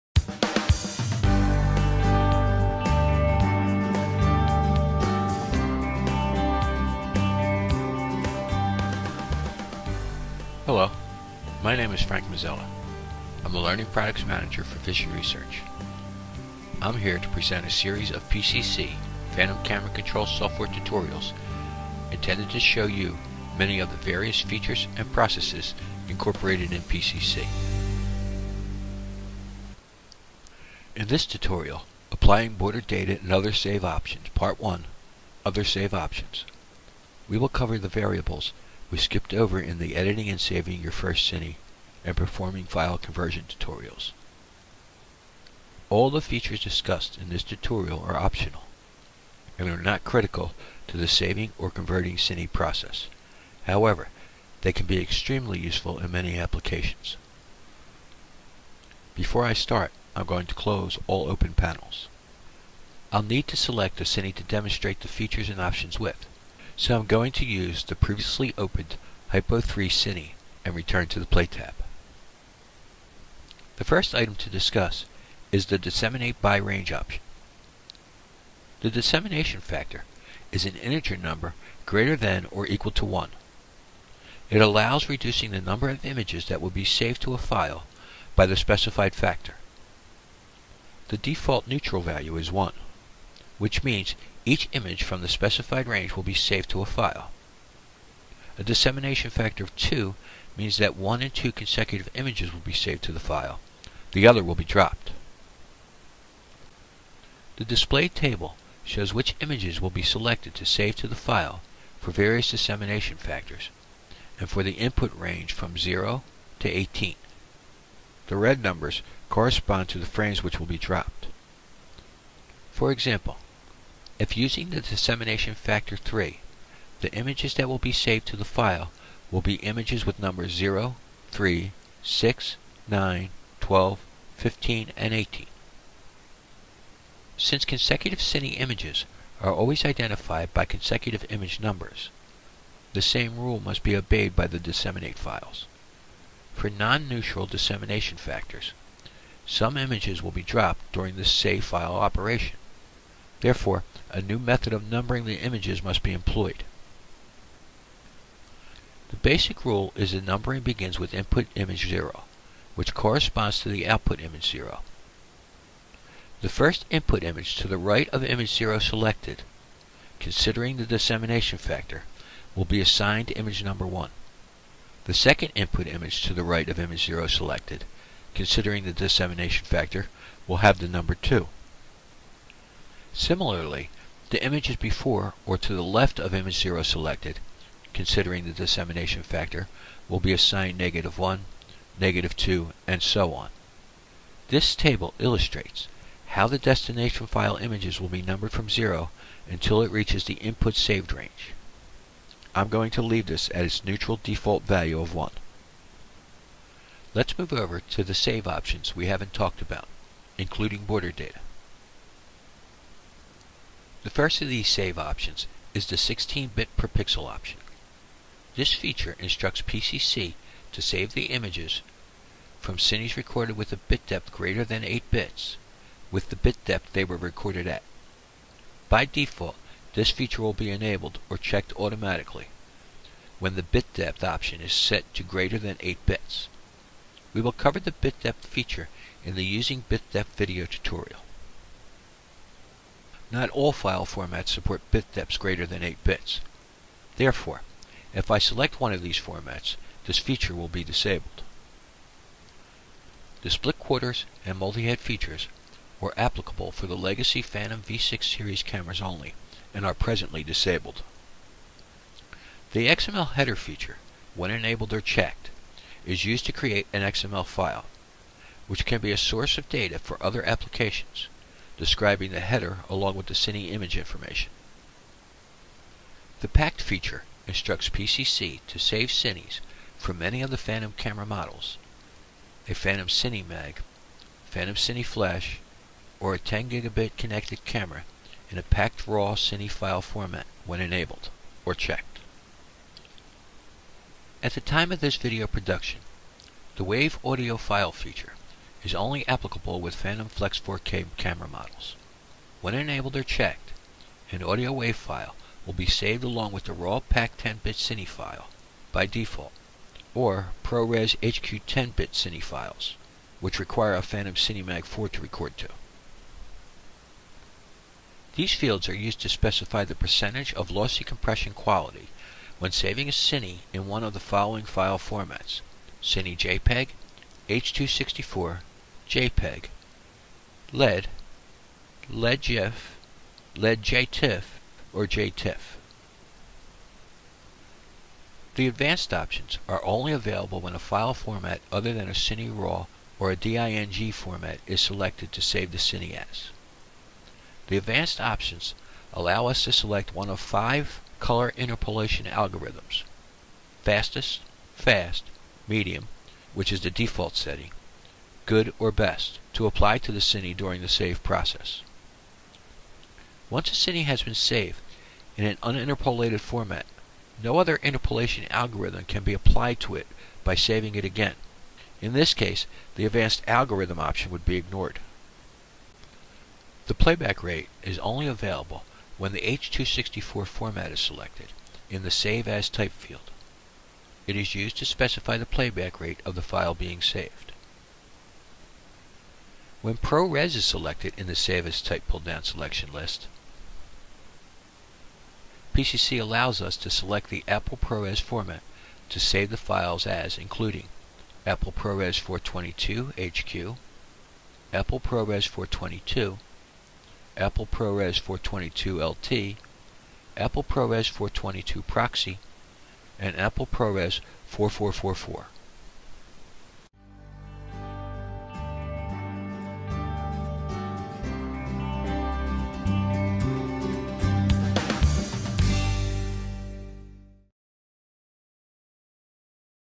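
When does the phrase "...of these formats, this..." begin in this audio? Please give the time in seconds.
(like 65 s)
248 s.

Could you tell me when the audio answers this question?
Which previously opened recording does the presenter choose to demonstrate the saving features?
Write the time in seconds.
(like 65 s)
69 s.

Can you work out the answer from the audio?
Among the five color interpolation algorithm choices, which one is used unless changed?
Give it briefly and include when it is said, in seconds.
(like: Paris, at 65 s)
medium, at 355 s.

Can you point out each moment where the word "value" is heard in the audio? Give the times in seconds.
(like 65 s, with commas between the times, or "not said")
92 s, 204 s.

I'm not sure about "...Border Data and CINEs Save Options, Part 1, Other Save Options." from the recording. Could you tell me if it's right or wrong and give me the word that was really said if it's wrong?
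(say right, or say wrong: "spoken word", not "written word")
wrong: "Other", not "CINEs".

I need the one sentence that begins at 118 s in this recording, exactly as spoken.
The red numbers correspond to the frames which will be dropped.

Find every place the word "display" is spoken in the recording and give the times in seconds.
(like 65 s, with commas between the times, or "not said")
107 s.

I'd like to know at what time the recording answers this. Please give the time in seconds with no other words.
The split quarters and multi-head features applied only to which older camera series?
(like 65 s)
257 s.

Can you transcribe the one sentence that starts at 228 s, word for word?
By default, this feature will be enabled or checked automatically when the bit depth option is set to greater than 8 bits.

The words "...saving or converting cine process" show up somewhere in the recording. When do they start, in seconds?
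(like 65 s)
51 s.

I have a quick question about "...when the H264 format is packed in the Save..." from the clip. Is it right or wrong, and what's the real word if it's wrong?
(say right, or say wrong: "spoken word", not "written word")
wrong: "selected", not "packed".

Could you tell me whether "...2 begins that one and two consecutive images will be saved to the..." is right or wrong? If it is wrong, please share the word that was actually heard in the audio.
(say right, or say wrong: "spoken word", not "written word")
wrong: "means", not "begins".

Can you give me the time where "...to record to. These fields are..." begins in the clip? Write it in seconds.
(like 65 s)
315 s.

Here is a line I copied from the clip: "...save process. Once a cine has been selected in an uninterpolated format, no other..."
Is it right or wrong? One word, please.
wrong.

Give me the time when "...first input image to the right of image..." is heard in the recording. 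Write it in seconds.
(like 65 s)
166 s.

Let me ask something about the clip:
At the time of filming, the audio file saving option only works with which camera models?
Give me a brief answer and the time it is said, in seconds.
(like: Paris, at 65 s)
Phantom Flex 4K, at 299 s.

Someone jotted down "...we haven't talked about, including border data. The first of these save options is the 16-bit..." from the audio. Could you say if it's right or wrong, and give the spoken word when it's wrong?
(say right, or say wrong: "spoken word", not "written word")
right.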